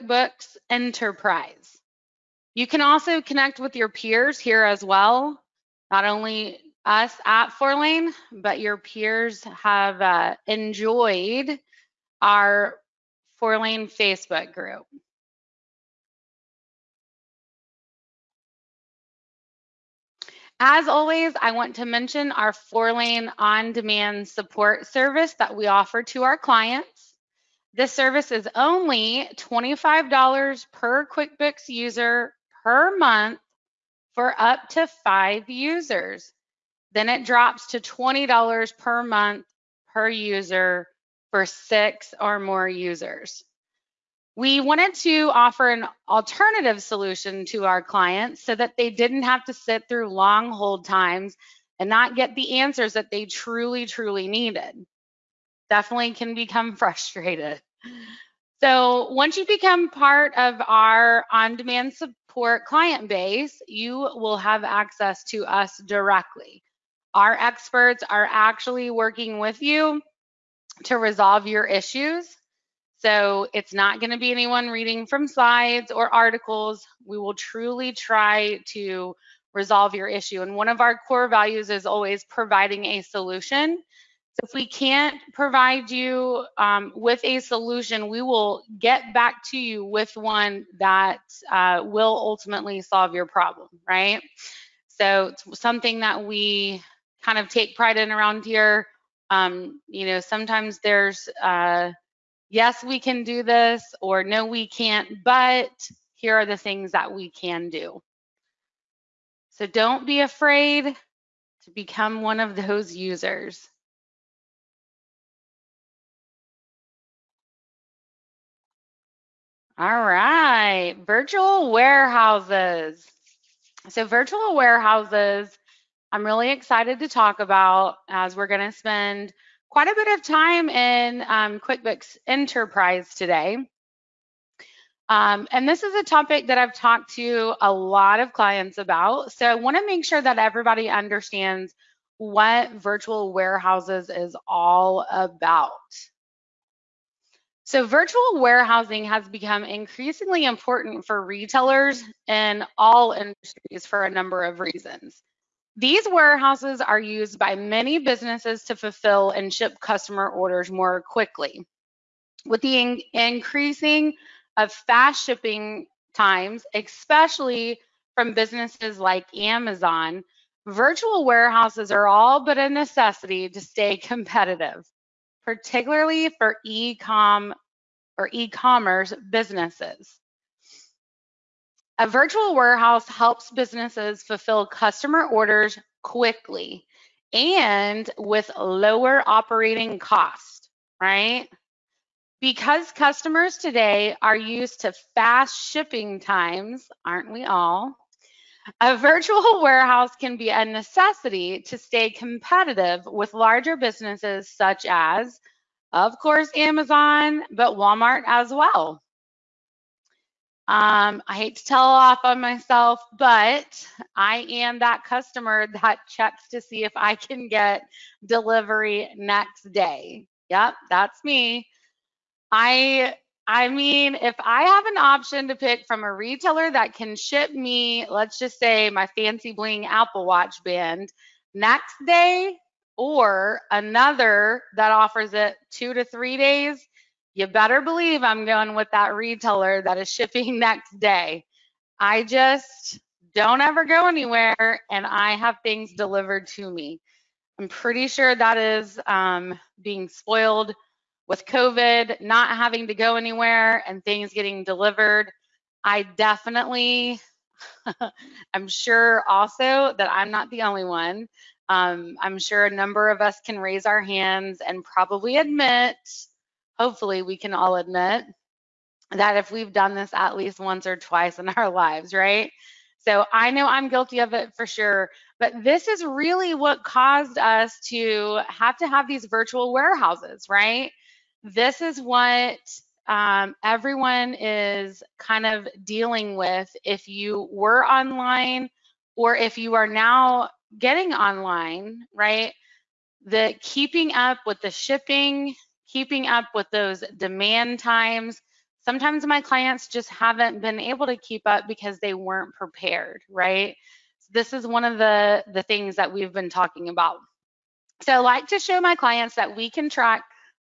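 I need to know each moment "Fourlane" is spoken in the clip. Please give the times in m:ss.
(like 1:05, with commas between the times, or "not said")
0:07, 0:13, 0:22.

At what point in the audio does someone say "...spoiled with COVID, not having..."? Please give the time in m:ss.
4:10.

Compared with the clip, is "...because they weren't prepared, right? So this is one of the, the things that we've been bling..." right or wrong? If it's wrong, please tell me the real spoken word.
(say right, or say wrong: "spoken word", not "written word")
wrong: "talking", not "bling".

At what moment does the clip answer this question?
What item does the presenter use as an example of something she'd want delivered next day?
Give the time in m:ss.
3:49.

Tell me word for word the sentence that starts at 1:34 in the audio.
So it's something that we kind of take pride in around here.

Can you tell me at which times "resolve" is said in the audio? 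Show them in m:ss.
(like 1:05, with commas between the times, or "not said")
1:10, 1:19.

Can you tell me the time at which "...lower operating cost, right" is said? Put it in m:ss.
3:08.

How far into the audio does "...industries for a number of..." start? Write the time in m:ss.
2:33.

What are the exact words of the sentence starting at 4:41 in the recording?
This is what um, everyone is kind of dealing with if you were online or if you are now getting online, right?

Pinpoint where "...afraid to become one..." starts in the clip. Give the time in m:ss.
1:50.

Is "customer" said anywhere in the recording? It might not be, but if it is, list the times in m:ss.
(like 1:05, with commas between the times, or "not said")
2:39, 3:04, 3:12, 3:35.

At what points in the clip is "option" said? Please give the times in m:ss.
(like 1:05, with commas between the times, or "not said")
3:44.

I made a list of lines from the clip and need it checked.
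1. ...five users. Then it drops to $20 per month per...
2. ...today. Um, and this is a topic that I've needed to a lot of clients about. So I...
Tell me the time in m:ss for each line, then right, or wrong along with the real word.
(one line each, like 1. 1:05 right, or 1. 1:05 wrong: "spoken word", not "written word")
1. 0:35 right
2. 2:13 wrong: "talked", not "needed".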